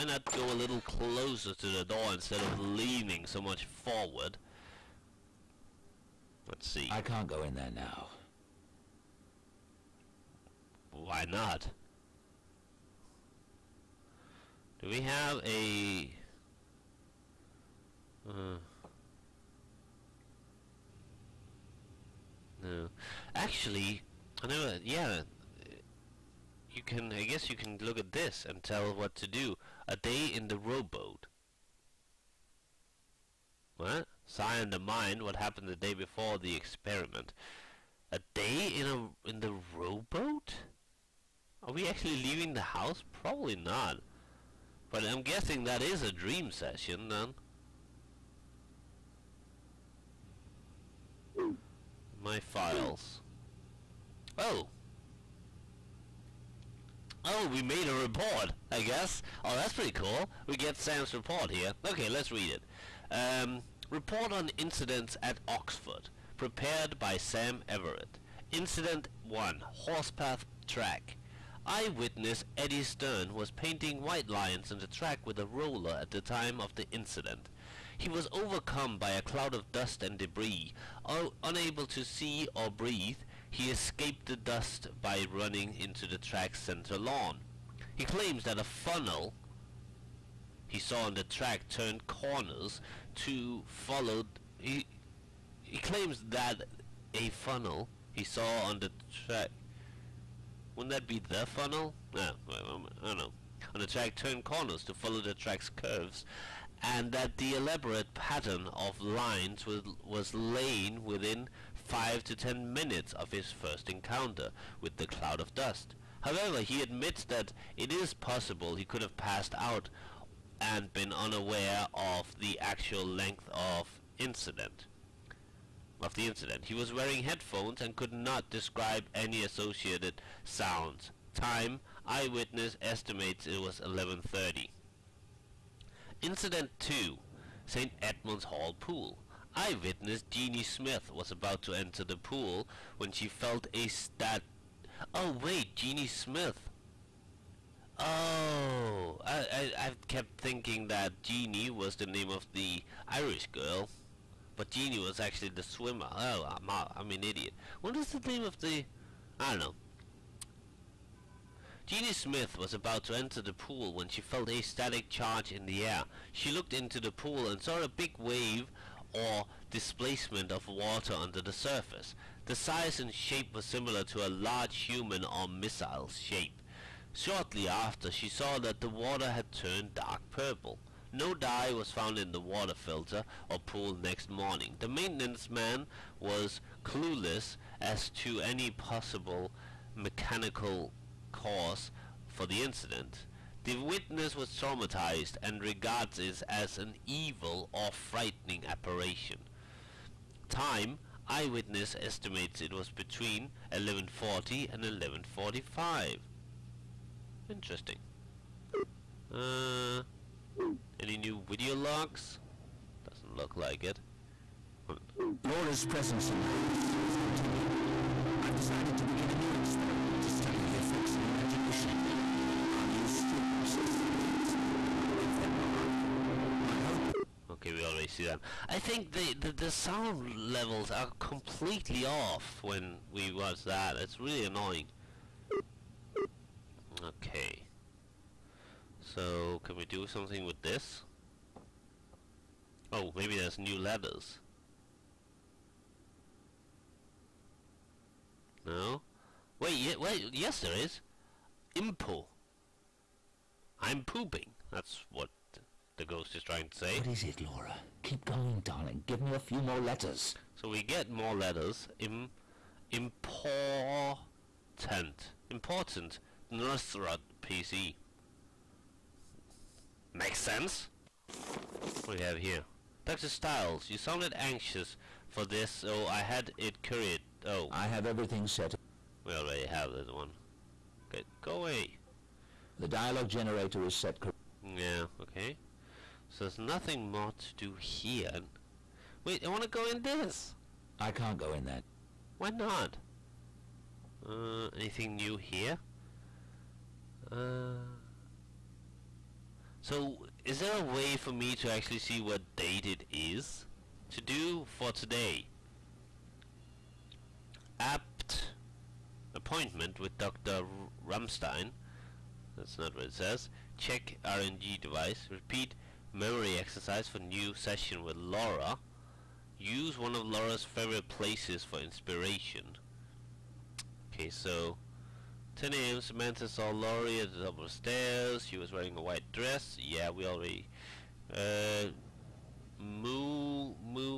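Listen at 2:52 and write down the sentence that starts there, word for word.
The size and shape was similar to a large human or missile shape.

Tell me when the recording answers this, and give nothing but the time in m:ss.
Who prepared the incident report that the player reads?
1:07.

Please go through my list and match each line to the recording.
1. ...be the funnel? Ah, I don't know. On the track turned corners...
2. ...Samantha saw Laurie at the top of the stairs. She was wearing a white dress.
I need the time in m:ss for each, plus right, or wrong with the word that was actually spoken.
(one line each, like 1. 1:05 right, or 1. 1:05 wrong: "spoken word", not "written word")
1. 1:41 right
2. 5:26 right.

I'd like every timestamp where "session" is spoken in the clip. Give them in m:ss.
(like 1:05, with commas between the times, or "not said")
0:46, 5:17.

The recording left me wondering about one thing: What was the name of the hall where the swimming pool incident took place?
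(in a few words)
St. Edmund's Hall.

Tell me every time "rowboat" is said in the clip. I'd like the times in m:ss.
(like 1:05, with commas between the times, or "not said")
0:30, 0:39.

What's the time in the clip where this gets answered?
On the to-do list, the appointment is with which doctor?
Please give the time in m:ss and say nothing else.
5:10.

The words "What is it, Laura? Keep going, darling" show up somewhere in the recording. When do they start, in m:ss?
4:16.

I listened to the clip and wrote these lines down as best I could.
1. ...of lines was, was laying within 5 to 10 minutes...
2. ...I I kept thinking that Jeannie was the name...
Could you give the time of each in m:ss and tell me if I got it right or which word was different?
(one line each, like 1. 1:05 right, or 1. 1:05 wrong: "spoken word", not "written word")
1. 1:48 right
2. 2:29 right.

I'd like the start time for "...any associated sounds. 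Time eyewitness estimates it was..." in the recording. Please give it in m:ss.
2:09.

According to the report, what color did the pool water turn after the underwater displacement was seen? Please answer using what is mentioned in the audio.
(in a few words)
Dark purple.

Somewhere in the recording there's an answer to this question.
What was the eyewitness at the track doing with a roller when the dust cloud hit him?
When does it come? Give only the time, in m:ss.
1:13.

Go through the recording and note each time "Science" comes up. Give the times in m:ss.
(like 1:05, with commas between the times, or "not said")
0:34.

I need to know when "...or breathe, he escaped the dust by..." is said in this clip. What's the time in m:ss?
1:22.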